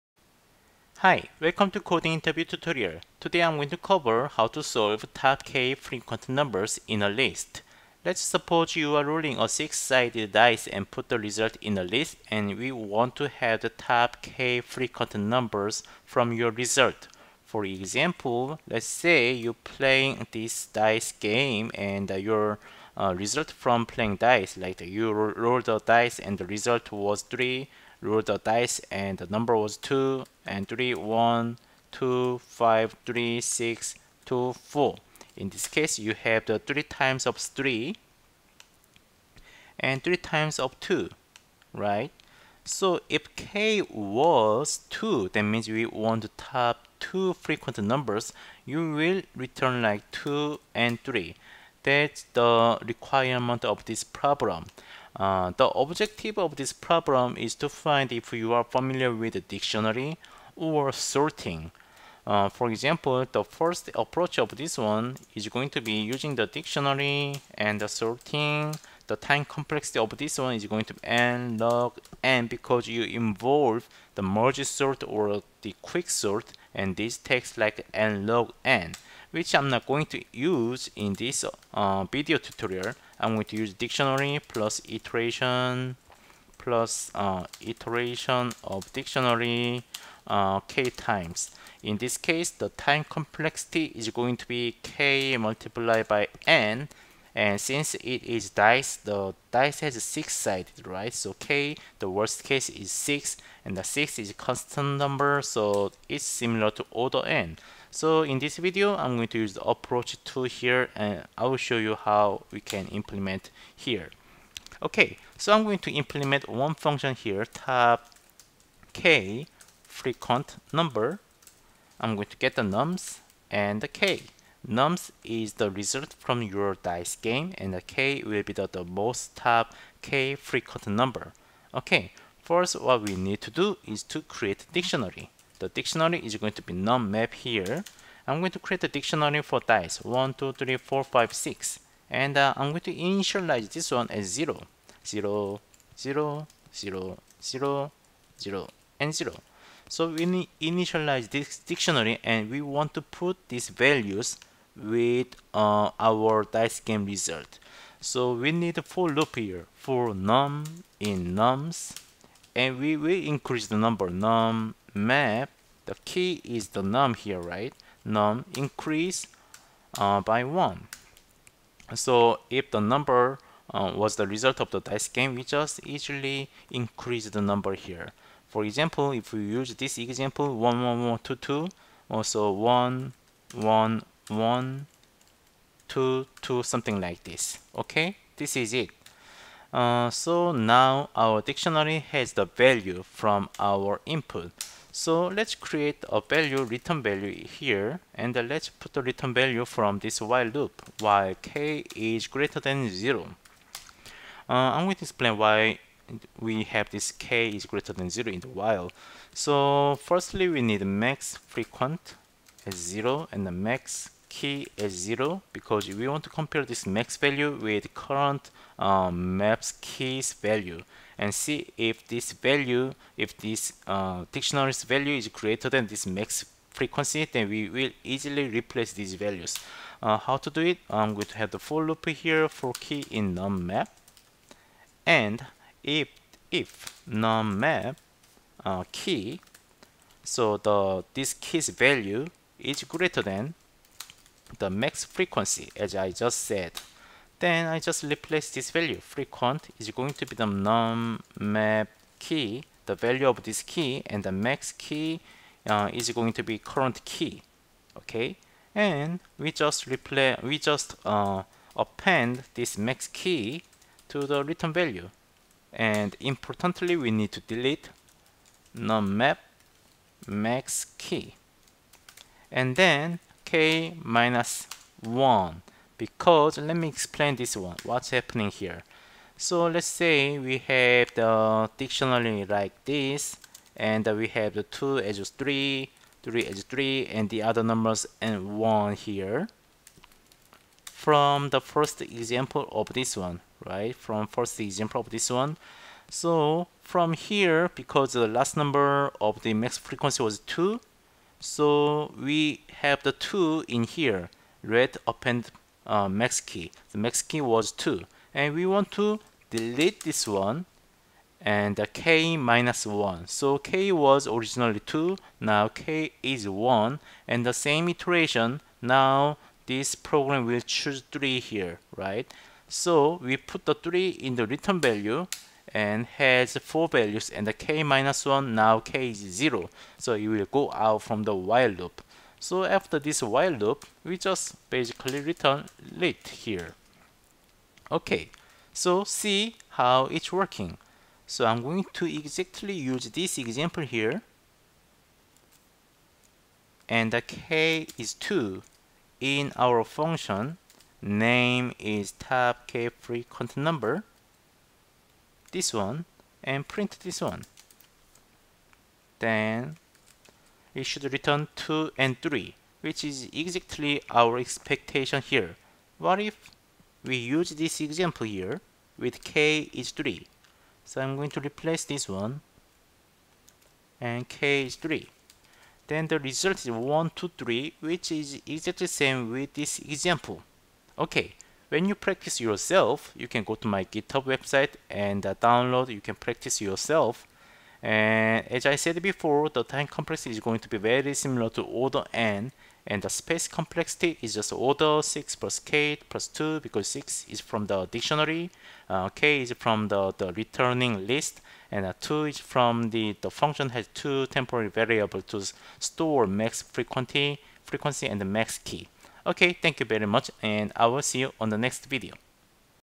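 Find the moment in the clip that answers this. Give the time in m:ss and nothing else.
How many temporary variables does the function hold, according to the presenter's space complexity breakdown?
6:43.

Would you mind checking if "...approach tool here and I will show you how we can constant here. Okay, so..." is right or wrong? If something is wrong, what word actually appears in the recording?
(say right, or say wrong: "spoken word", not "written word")
wrong: "implement", not "constant".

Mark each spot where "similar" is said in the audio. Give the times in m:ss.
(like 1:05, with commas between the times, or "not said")
1:46, 6:31.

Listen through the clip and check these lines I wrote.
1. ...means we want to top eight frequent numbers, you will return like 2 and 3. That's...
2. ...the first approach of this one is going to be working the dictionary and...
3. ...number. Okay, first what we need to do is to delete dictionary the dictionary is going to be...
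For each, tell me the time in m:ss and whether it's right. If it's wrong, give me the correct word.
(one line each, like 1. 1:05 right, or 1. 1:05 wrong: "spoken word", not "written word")
1. 0:45 wrong: "two", not "eight"
2. 1:03 wrong: "using", not "working"
3. 2:10 wrong: "create", not "delete".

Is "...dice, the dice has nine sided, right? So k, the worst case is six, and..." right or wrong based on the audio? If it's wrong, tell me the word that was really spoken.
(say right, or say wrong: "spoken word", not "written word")
wrong: "six", not "nine".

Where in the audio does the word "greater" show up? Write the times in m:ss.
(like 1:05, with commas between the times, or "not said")
3:22, 3:27, 3:45, 4:02.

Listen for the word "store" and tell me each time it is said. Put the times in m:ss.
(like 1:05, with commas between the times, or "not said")
6:45.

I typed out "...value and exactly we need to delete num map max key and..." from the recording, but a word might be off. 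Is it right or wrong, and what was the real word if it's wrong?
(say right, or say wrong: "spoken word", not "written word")
wrong: "importantly", not "exactly".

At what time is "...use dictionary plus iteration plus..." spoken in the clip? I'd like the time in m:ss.
1:23.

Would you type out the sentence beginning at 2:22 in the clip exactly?
And uh, I'm going to initialize this one as 0.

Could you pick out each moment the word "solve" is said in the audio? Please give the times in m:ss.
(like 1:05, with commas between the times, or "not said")
0:04.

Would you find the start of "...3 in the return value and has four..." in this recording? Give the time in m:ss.
5:23.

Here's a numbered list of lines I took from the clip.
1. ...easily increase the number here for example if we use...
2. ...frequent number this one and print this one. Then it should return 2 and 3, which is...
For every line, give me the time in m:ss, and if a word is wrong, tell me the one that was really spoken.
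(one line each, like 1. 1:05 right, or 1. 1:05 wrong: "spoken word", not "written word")
1. 2:55 right
2. 5:52 right.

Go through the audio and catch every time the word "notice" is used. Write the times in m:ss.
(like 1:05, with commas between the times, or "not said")
not said.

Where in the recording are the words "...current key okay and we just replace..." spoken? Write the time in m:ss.
4:16.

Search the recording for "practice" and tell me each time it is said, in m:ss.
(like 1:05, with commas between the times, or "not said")
6:21, 6:26.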